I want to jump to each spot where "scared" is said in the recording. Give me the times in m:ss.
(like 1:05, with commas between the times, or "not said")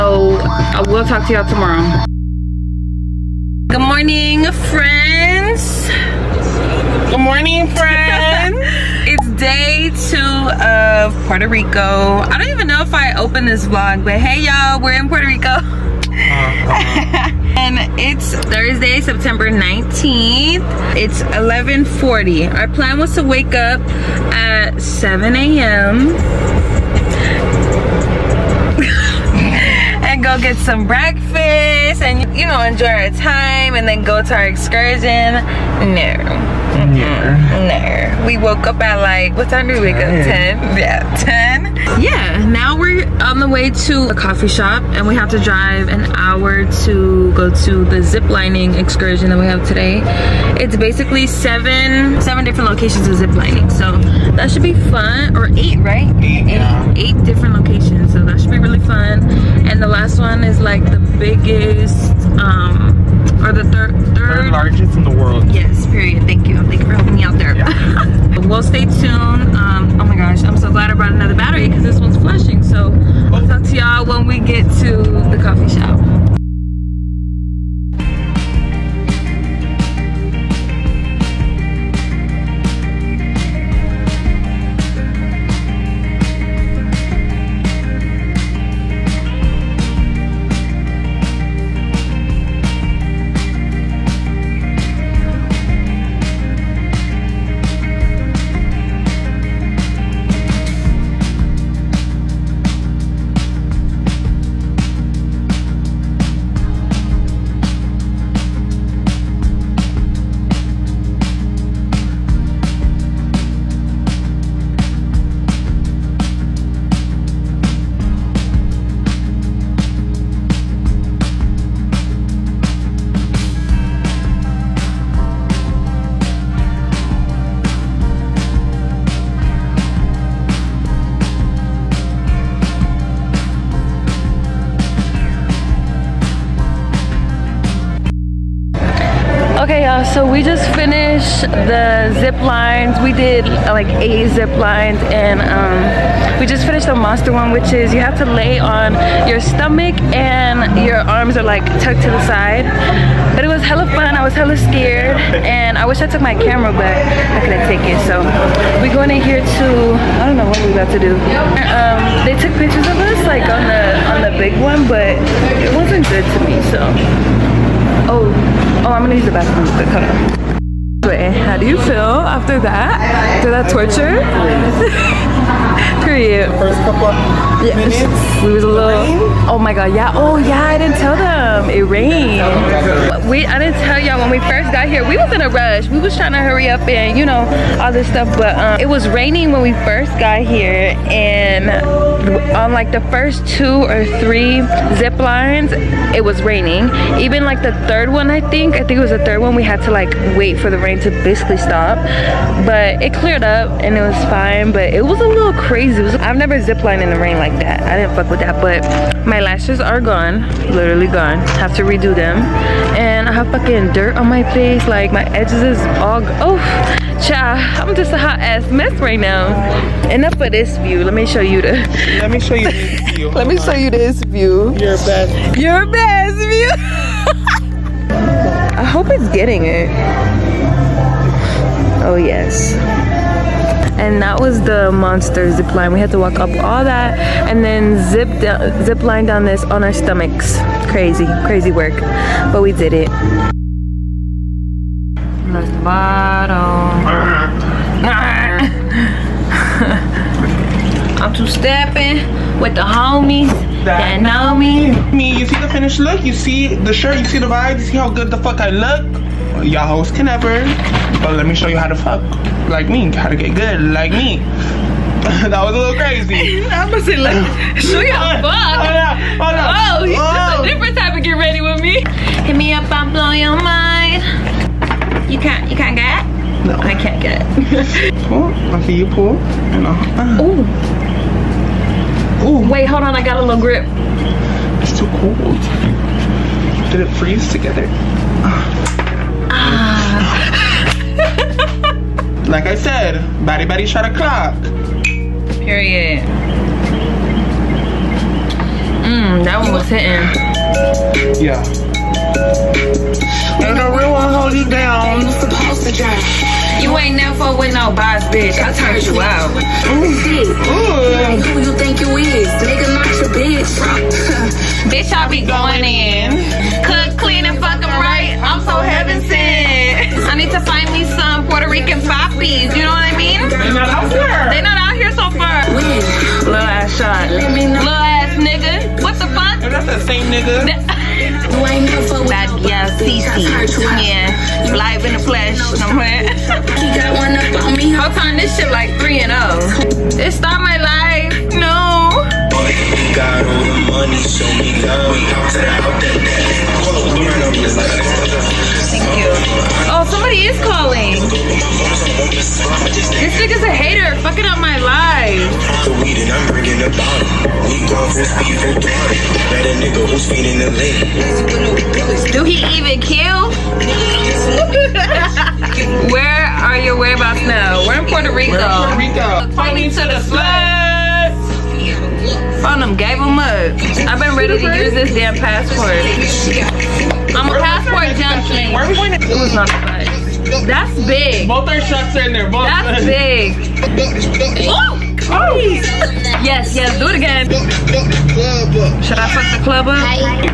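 2:34.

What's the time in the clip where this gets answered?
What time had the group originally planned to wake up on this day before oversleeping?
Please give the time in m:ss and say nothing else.
0:24.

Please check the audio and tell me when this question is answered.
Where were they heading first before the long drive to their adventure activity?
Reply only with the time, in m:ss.
0:44.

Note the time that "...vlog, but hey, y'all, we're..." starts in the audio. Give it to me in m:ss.
0:13.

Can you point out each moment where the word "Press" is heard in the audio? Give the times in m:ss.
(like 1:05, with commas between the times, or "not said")
4:05.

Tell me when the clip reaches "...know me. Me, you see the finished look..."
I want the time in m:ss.
4:14.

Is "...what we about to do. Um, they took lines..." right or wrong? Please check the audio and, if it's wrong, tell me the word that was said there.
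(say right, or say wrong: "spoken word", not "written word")
wrong: "pictures", not "lines".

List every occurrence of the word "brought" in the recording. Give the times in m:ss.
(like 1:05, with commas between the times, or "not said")
1:10.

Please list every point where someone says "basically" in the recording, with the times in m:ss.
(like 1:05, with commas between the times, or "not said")
0:50, 3:21.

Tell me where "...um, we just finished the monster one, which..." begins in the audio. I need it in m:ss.
2:25.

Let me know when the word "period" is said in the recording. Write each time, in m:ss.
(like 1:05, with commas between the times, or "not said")
1:05, 2:56, 4:55.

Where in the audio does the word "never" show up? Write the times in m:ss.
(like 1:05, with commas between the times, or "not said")
3:26, 4:20, 5:07.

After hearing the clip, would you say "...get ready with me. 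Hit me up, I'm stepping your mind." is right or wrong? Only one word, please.
wrong.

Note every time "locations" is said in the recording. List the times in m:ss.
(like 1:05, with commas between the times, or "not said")
0:52, 0:57.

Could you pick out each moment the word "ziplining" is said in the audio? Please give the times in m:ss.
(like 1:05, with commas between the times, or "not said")
0:48, 0:53.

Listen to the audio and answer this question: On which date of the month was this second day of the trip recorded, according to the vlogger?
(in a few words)
19th.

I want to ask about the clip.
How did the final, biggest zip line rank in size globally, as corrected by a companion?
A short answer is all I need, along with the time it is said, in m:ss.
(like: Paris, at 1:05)
third largest, at 1:04.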